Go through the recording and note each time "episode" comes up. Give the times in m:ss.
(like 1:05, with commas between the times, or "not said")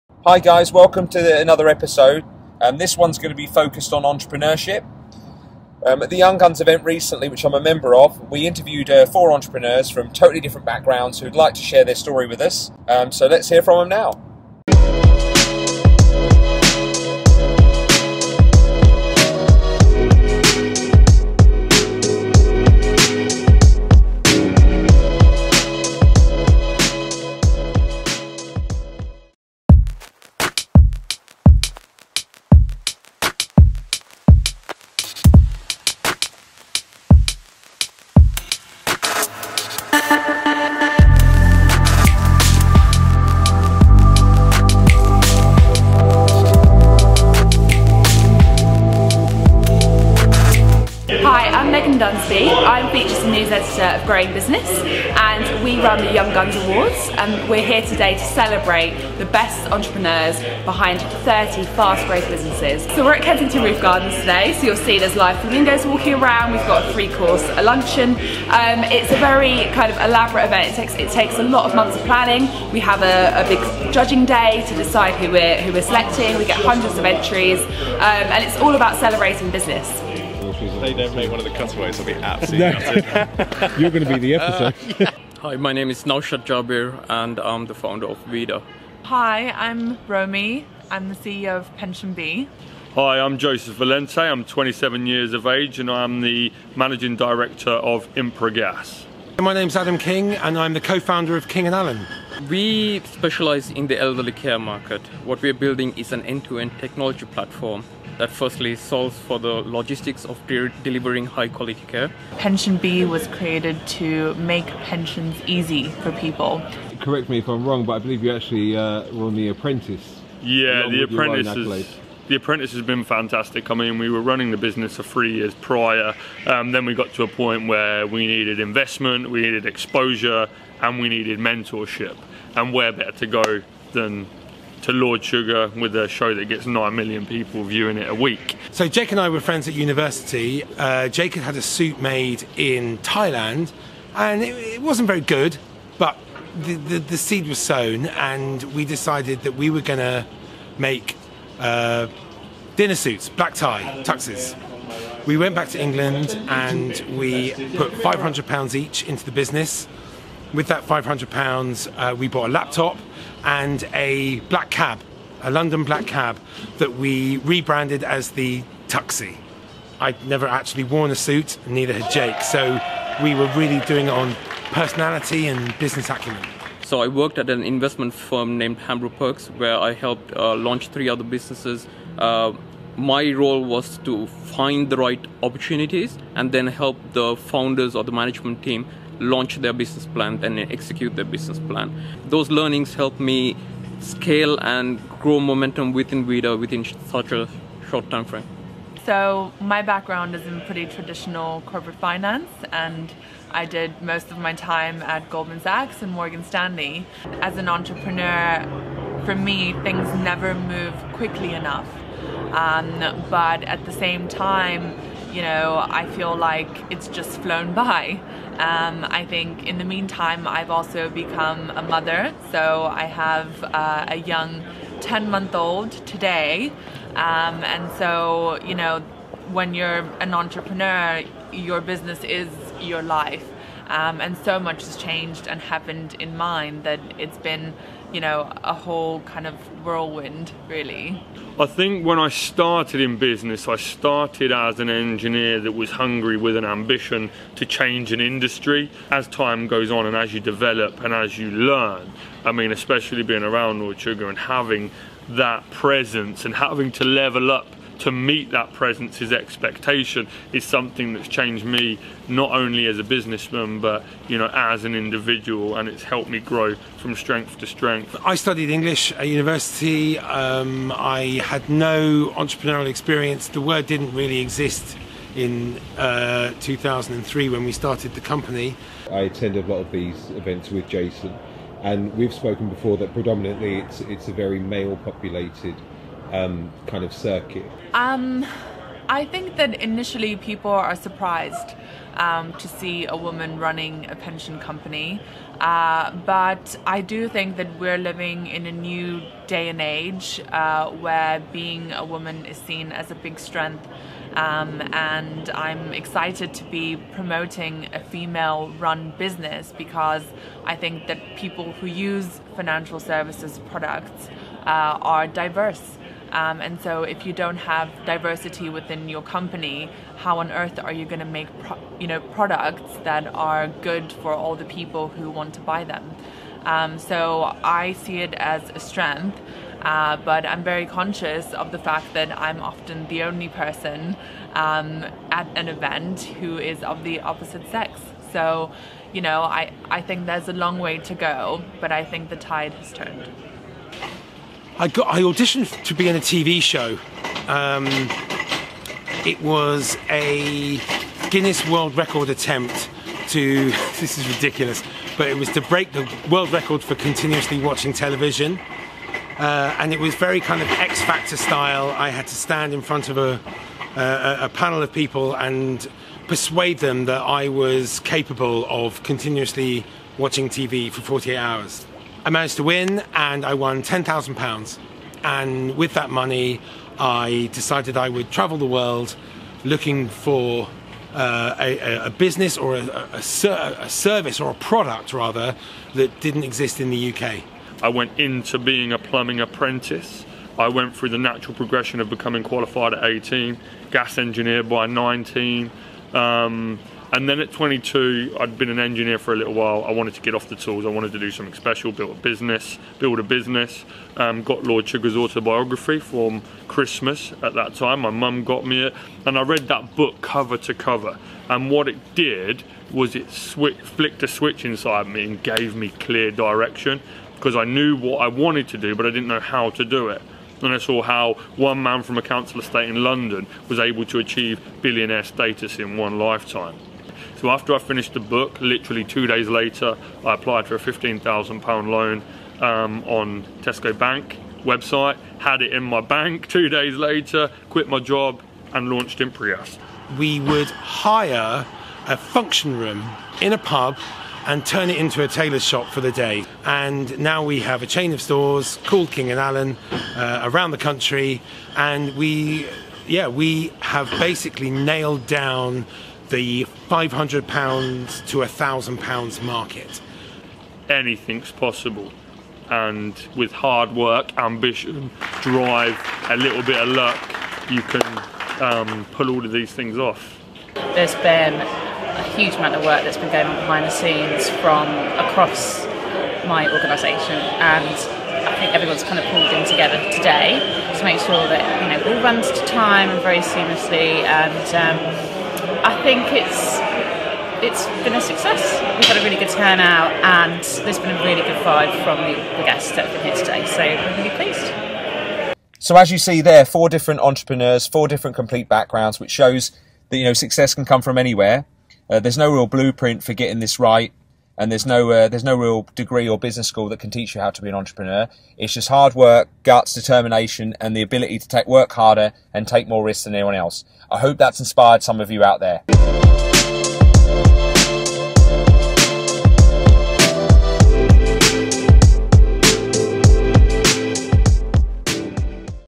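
0:01, 1:24.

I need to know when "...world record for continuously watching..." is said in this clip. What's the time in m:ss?
5:56.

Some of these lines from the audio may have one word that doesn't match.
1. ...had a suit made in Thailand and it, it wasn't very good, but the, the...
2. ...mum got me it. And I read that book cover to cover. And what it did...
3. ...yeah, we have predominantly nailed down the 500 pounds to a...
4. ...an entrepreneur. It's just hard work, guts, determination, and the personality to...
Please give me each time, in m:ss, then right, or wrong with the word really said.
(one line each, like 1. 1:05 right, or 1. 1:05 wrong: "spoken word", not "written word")
1. 2:21 right
2. 6:48 right
3. 7:33 wrong: "basically", not "predominantly"
4. 8:27 wrong: "ability", not "personality".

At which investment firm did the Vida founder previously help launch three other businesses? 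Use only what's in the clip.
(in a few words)
Hambro Perks.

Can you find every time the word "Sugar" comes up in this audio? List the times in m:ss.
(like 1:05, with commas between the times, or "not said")
2:15, 4:13, 6:44.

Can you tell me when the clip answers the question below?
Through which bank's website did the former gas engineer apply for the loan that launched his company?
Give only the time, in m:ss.
7:13.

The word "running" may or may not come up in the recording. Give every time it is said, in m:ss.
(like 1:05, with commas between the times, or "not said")
2:04, 4:53.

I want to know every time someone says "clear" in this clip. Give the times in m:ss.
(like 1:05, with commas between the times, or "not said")
6:55.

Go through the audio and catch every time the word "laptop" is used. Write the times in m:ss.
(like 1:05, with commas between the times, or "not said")
2:42.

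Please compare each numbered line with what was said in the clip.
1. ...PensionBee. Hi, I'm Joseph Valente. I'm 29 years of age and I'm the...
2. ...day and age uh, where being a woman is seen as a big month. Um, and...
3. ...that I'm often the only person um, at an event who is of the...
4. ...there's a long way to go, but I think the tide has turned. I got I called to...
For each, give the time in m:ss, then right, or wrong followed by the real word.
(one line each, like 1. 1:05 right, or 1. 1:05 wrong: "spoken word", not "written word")
1. 1:31 wrong: "27", not "29"
2. 4:59 wrong: "strength", not "month"
3. 5:32 right
4. 5:40 wrong: "auditioned", not "called".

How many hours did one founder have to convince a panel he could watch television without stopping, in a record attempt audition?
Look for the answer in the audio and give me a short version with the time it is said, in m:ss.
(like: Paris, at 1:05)
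48, at 6:11.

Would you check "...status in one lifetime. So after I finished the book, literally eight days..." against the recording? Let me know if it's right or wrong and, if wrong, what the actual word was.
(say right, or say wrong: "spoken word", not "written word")
wrong: "two", not "eight".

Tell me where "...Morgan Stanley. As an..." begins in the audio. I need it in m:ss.
3:26.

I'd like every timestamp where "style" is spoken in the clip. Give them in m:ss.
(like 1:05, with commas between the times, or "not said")
6:01.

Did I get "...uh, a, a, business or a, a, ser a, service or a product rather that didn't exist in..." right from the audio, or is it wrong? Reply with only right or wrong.
right.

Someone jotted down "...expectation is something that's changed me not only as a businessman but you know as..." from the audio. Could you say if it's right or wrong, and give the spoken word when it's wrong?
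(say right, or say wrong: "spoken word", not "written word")
right.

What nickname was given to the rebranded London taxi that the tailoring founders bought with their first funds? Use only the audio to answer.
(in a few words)
the Tuxie.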